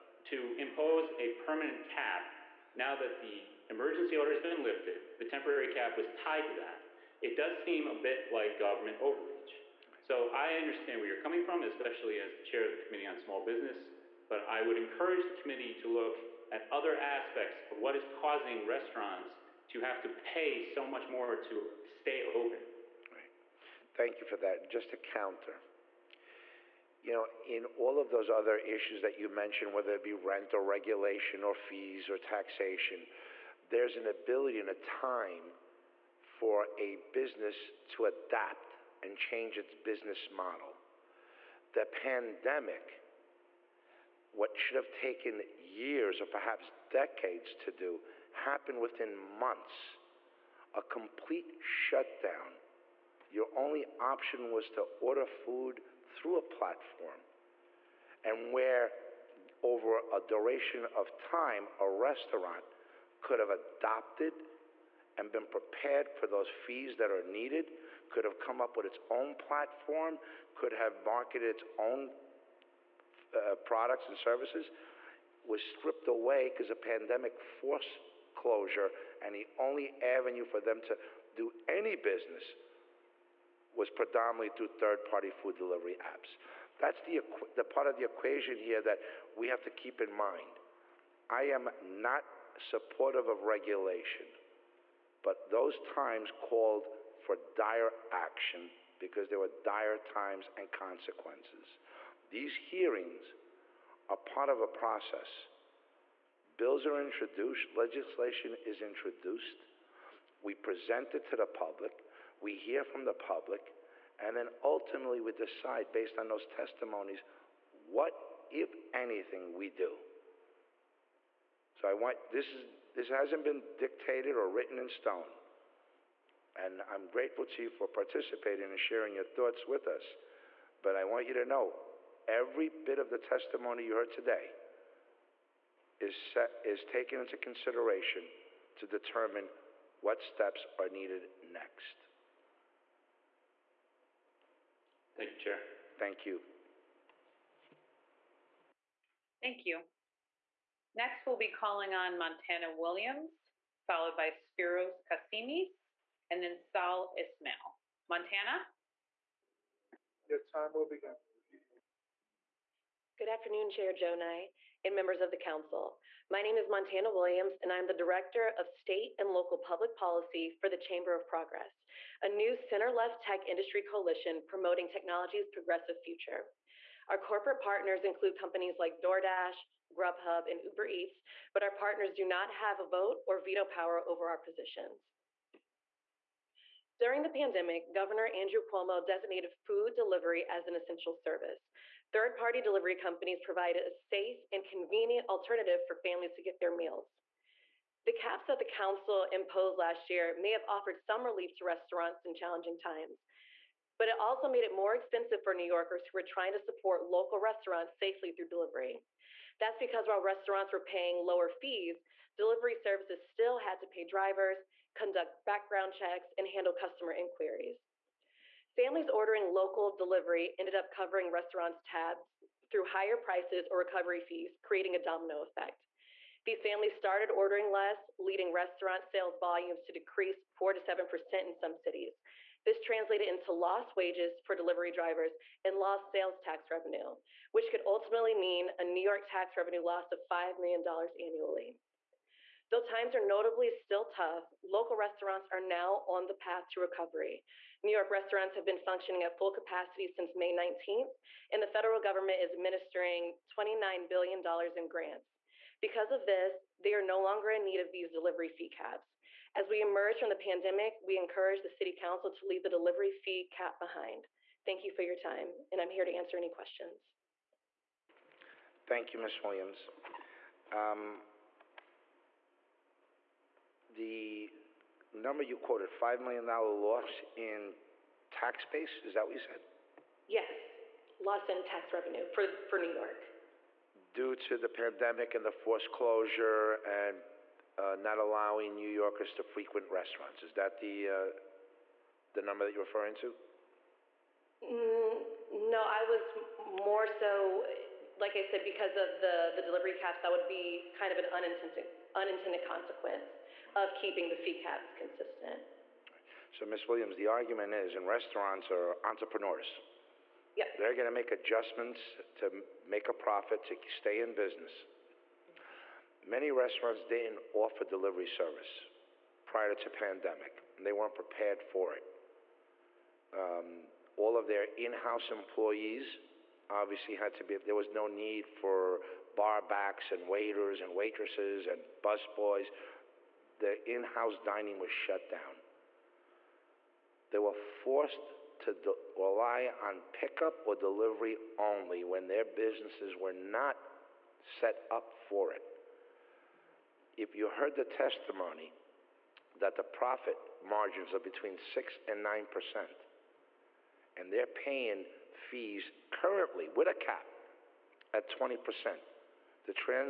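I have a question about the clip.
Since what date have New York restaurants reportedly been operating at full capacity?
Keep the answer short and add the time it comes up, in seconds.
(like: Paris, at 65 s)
May 19th, at 250 s.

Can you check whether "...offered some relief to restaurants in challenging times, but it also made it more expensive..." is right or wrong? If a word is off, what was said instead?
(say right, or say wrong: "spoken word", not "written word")
right.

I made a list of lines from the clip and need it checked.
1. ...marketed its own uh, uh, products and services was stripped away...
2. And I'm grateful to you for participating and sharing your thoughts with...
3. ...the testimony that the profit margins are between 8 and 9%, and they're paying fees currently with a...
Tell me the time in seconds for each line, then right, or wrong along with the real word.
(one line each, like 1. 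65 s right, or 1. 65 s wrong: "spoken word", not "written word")
1. 71 s right
2. 126 s right
3. 347 s wrong: "6", not "8".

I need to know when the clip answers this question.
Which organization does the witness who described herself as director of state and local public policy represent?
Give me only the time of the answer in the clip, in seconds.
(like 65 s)
170 s.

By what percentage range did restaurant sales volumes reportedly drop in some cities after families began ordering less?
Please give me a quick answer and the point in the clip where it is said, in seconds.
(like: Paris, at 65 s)
4 to 7%, at 230 s.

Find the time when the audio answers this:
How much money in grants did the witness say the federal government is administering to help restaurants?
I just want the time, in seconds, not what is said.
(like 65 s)
253 s.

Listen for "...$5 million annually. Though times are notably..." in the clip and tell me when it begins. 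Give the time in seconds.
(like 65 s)
240 s.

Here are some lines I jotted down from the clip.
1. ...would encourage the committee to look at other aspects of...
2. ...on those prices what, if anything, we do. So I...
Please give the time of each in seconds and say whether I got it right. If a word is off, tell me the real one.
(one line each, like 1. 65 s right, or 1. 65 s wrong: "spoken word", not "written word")
1. 14 s right
2. 116 s wrong: "testimonies", not "prices".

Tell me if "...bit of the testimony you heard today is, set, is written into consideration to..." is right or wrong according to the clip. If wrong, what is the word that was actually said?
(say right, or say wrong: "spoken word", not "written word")
wrong: "taken", not "written".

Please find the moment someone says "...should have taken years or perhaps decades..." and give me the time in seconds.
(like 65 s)
44 s.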